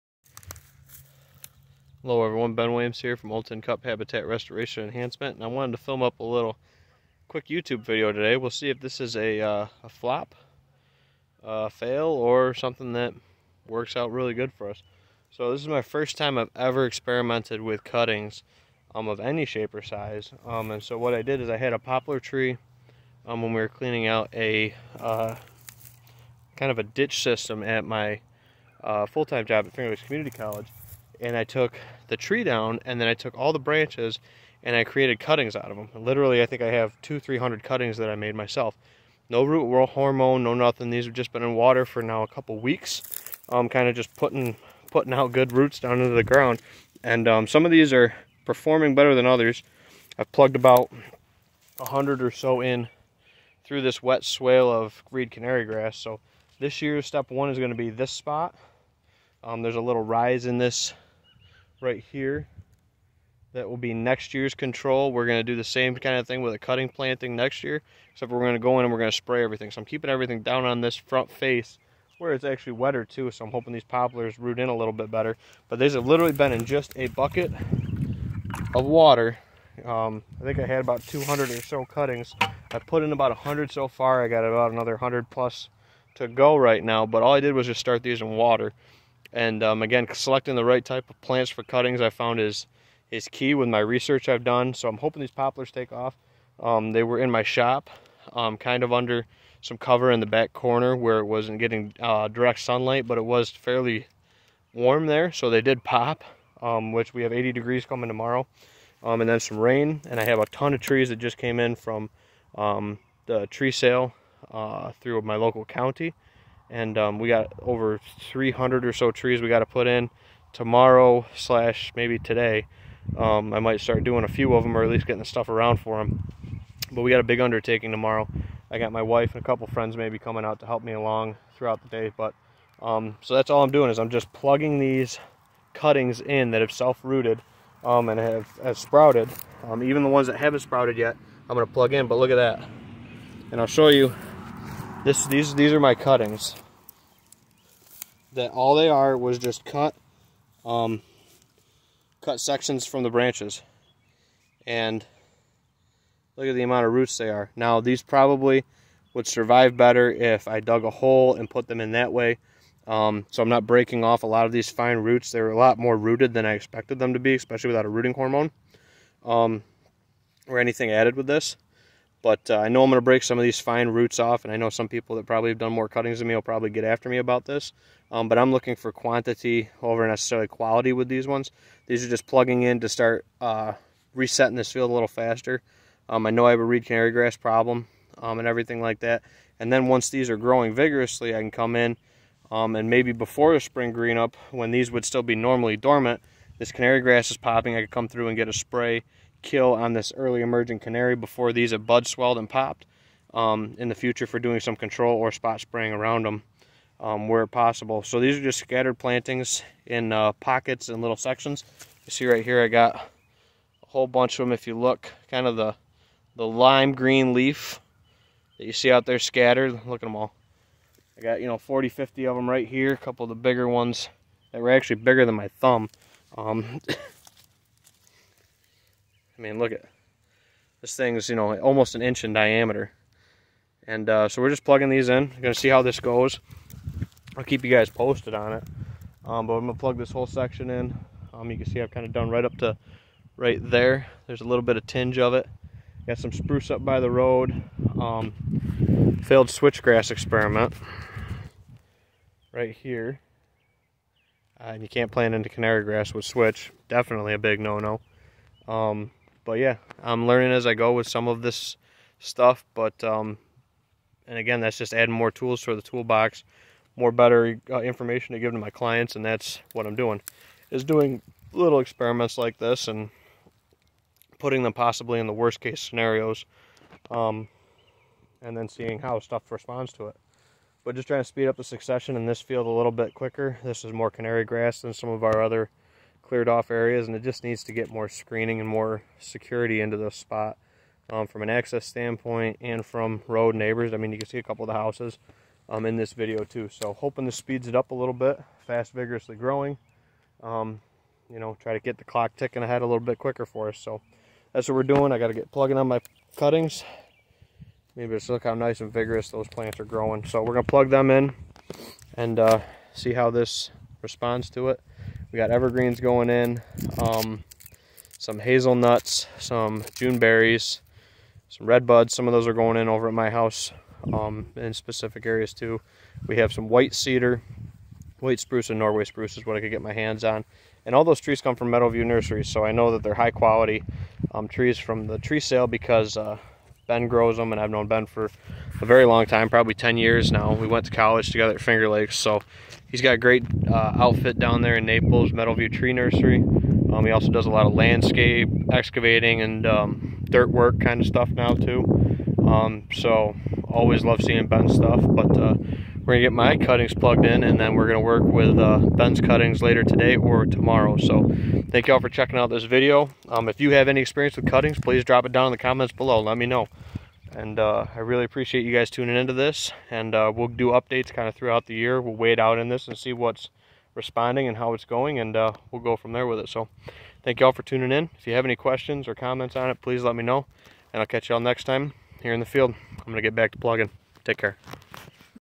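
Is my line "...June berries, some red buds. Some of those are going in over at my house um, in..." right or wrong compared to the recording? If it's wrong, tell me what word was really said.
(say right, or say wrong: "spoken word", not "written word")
right.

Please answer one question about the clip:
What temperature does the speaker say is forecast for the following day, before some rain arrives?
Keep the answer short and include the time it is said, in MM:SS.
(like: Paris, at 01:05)
80 degrees, at 01:47.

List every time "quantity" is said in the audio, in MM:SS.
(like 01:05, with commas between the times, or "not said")
02:58.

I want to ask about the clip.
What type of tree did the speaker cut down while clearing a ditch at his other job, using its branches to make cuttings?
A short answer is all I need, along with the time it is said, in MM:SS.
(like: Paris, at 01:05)
Poplar, at 00:21.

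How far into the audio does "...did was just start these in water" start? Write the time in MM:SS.
01:27.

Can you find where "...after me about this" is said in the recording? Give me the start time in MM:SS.
02:56.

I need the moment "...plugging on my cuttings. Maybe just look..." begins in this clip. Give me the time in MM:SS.
05:05.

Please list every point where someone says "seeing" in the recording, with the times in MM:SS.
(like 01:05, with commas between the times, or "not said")
04:38, 05:54.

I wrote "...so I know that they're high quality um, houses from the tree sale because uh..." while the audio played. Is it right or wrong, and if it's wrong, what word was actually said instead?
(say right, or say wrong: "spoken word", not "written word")
wrong: "trees", not "houses".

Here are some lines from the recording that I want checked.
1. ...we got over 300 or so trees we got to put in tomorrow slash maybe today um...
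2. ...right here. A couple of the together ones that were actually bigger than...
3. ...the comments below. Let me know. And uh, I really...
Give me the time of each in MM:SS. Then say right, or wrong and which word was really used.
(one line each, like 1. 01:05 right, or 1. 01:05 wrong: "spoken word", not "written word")
1. 01:57 right
2. 03:42 wrong: "bigger", not "together"
3. 06:05 right.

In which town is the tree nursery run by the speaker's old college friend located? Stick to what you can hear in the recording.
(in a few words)
Naples.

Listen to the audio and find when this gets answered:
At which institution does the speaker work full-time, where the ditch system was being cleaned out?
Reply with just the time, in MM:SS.
00:29.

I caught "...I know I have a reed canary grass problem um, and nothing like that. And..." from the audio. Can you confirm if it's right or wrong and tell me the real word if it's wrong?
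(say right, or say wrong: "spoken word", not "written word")
wrong: "everything", not "nothing".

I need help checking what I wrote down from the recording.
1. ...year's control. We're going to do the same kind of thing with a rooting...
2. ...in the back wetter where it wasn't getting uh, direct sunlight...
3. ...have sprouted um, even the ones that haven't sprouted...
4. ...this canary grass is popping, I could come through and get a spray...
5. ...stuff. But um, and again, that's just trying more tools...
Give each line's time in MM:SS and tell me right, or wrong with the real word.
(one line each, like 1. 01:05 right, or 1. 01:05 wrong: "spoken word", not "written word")
1. 01:04 wrong: "cutting", not "rooting"
2. 01:40 wrong: "corner", not "wetter"
3. 02:18 right
4. 03:16 right
5. 04:22 wrong: "adding", not "trying".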